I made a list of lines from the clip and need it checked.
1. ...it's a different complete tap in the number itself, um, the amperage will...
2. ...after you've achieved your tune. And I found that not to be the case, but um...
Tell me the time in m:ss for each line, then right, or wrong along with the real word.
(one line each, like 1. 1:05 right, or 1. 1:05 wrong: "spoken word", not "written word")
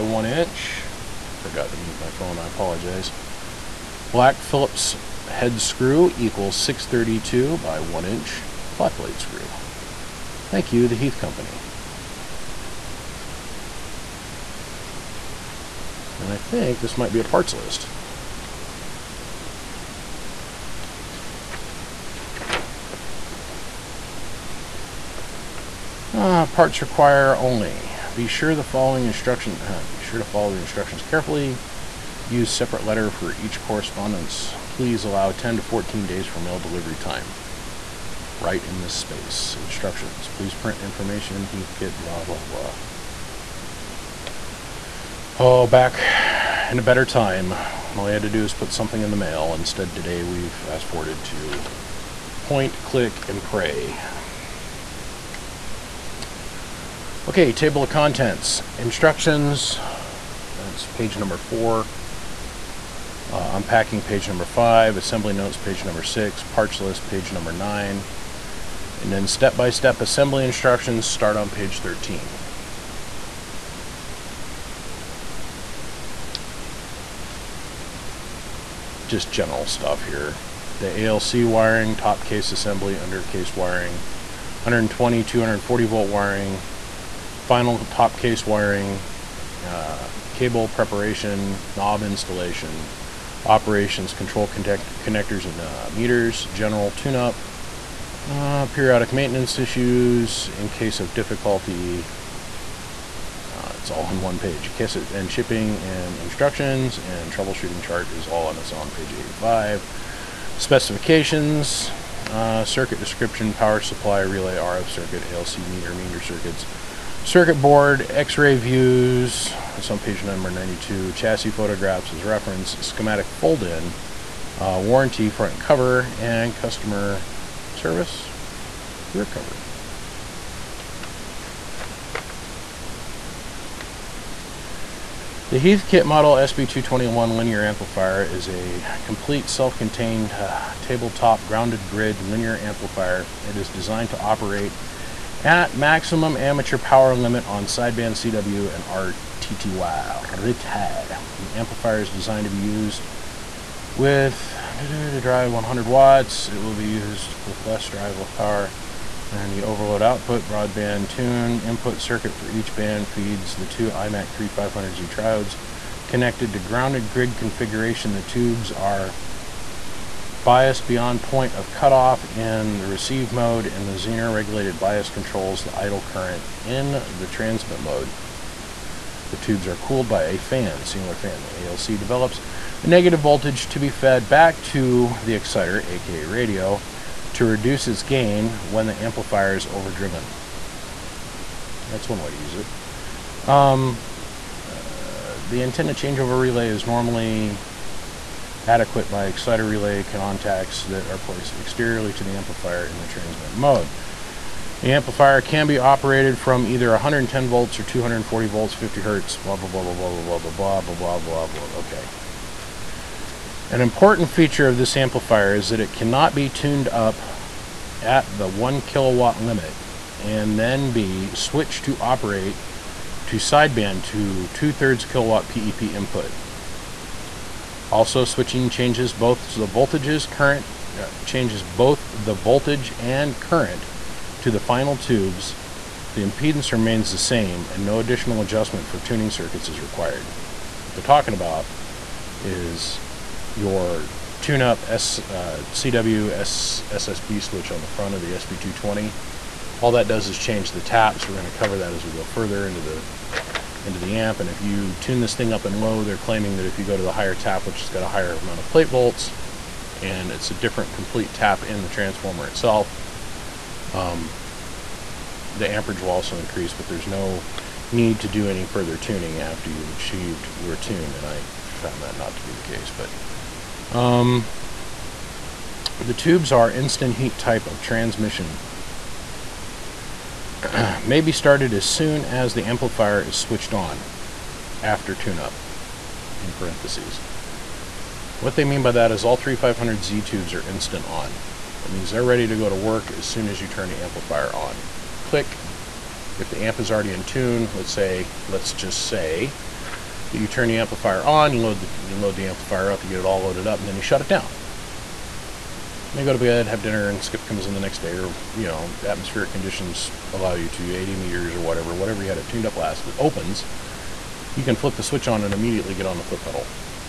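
1. 4:20 wrong: "transformer", not "number"
2. 4:29 right.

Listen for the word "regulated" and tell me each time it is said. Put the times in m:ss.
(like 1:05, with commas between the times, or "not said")
2:54.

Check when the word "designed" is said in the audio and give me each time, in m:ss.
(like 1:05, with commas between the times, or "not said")
2:23, 2:32.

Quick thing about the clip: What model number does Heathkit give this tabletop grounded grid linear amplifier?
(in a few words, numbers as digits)
SB221.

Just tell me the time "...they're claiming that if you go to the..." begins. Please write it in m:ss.
4:16.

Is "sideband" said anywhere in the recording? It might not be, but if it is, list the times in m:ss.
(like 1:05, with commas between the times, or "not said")
2:27, 3:43.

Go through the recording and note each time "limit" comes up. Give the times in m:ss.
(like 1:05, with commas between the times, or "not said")
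2:27, 3:39.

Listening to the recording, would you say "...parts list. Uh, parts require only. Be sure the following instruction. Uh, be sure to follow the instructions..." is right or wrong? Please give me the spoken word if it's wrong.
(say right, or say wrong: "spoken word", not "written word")
right.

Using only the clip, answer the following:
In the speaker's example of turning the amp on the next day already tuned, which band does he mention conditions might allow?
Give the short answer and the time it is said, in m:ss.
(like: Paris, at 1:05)
80 meters, at 5:10.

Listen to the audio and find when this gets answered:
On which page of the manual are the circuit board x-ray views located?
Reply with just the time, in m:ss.
1:59.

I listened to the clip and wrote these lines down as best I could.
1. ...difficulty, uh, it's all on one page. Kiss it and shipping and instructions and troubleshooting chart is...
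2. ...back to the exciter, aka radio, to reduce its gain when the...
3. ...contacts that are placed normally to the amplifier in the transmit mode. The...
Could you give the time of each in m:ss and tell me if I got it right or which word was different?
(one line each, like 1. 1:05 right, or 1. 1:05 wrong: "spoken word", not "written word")
1. 1:41 right
2. 3:04 right
3. 3:20 wrong: "exteriorly", not "normally".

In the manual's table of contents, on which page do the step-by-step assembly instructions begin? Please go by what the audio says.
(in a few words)
13.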